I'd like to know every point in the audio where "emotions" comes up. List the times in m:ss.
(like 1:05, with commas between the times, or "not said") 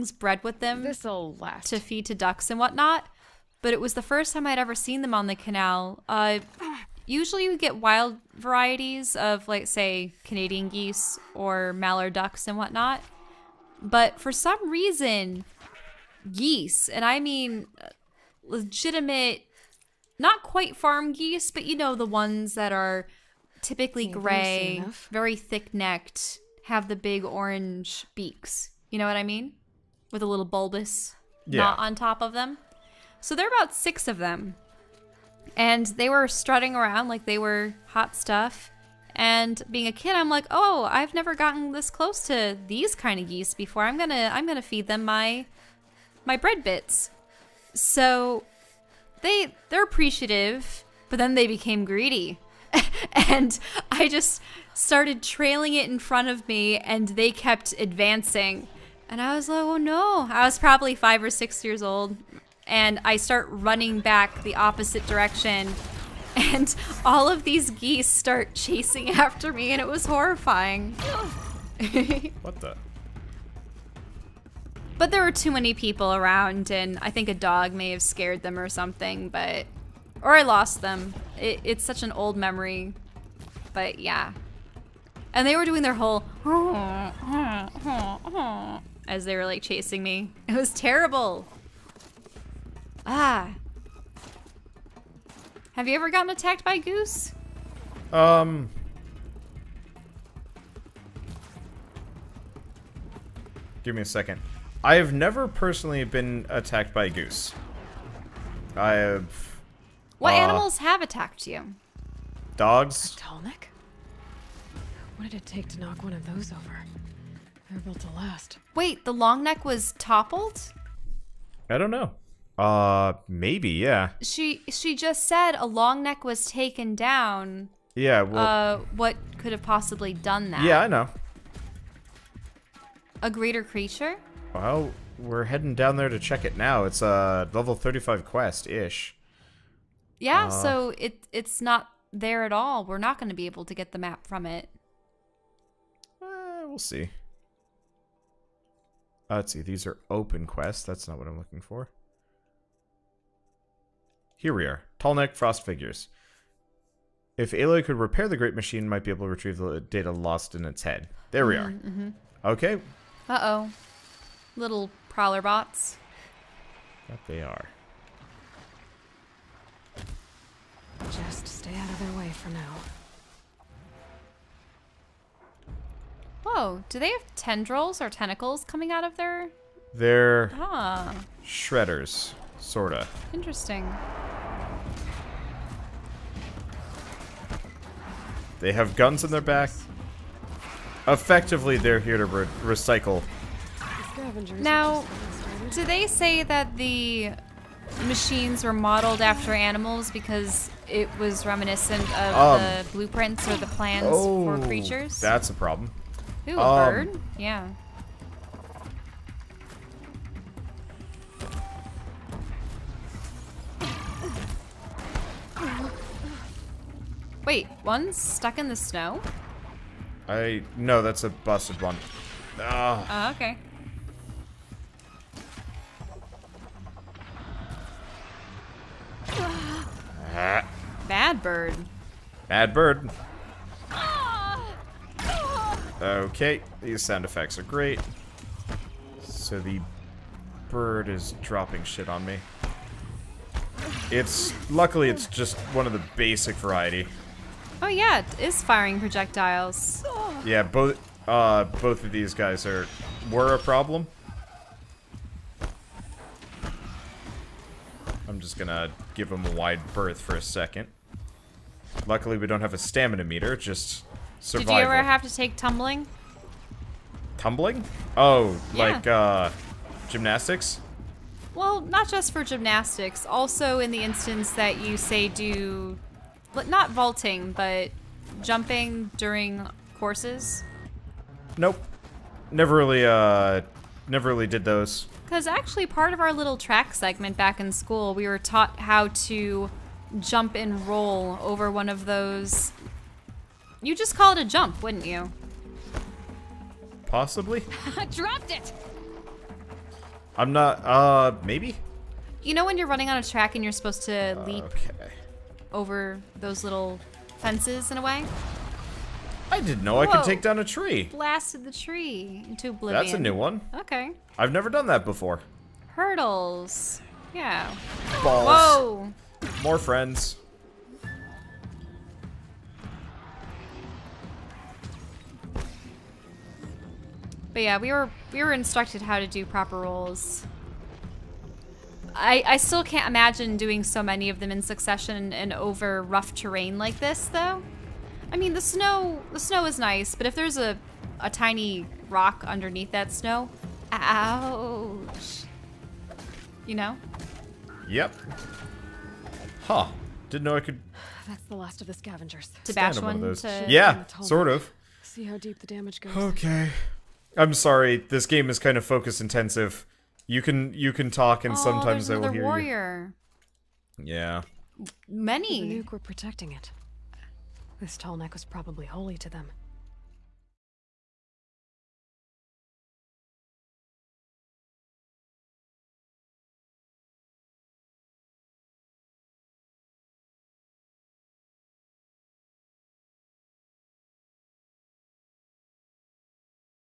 not said.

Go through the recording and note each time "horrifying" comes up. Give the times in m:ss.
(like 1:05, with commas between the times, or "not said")
1:10.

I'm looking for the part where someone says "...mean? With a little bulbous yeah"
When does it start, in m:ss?
0:29.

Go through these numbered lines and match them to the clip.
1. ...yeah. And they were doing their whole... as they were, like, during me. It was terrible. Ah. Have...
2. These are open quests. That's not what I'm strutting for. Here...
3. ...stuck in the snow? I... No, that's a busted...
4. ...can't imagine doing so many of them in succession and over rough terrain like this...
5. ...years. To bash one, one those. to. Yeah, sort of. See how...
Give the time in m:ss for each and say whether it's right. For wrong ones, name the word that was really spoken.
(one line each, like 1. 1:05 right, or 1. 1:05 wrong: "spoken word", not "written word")
1. 1:23 wrong: "chasing", not "during"
2. 2:29 wrong: "looking", not "strutting"
3. 3:38 right
4. 5:32 right
5. 5:51 wrong: "scavengers", not "years".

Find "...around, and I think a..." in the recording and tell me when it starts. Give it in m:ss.
1:16.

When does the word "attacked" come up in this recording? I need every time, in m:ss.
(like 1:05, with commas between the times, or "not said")
1:36, 1:46, 1:51.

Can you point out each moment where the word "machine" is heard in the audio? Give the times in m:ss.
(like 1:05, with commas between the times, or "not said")
2:38, 3:18.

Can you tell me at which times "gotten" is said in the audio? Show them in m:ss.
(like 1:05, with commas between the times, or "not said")
0:41, 1:36.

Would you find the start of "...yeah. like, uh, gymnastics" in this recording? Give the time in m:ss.
4:28.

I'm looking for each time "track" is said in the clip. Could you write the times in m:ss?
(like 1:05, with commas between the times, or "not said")
4:46, 5:03.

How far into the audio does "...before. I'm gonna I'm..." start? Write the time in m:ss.
0:43.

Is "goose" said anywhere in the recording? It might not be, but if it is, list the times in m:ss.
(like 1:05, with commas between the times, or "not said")
1:36, 1:47.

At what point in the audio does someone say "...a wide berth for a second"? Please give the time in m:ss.
4:19.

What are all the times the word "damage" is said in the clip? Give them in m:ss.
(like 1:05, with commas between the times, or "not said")
5:55.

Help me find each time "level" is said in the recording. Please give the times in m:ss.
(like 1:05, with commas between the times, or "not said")
2:17.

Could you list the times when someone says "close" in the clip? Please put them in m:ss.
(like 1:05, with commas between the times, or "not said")
0:41.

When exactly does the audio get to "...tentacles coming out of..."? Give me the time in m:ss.
2:58.